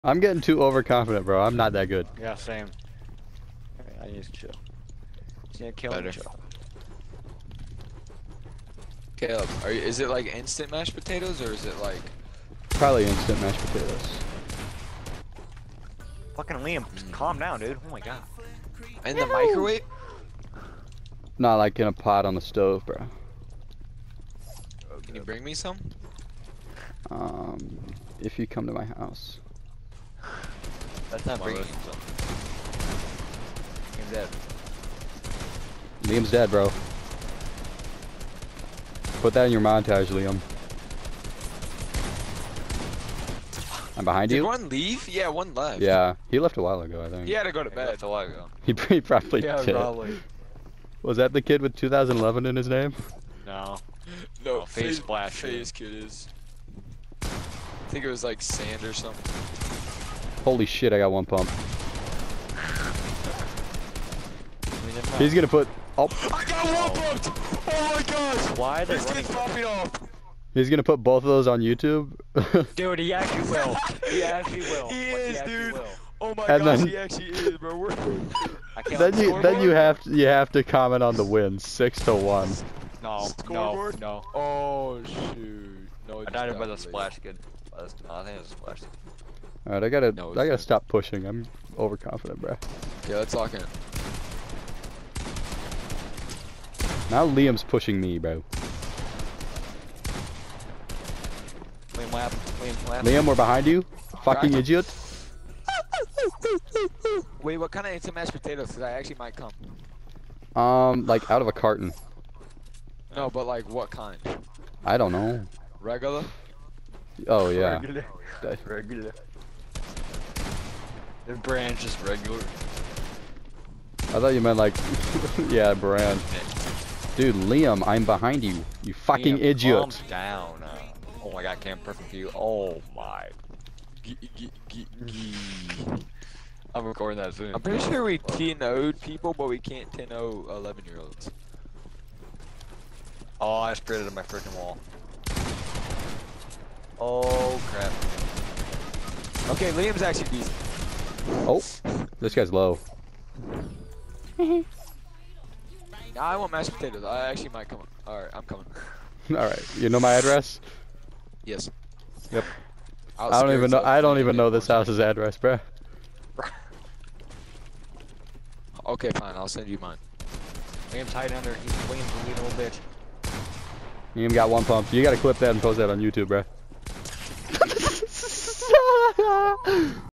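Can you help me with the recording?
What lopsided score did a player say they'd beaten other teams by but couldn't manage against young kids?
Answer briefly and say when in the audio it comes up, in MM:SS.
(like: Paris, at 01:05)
10-0, at 02:18.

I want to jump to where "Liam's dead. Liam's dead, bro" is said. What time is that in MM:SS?
00:33.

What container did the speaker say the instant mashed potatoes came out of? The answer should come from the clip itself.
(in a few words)
A carton.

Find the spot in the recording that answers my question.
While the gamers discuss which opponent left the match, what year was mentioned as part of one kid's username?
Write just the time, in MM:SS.
00:51.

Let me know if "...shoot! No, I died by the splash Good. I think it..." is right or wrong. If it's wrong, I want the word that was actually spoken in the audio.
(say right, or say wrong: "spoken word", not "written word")
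right.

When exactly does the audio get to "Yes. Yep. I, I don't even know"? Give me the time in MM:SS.
02:41.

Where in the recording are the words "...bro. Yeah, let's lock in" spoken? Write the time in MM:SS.
01:32.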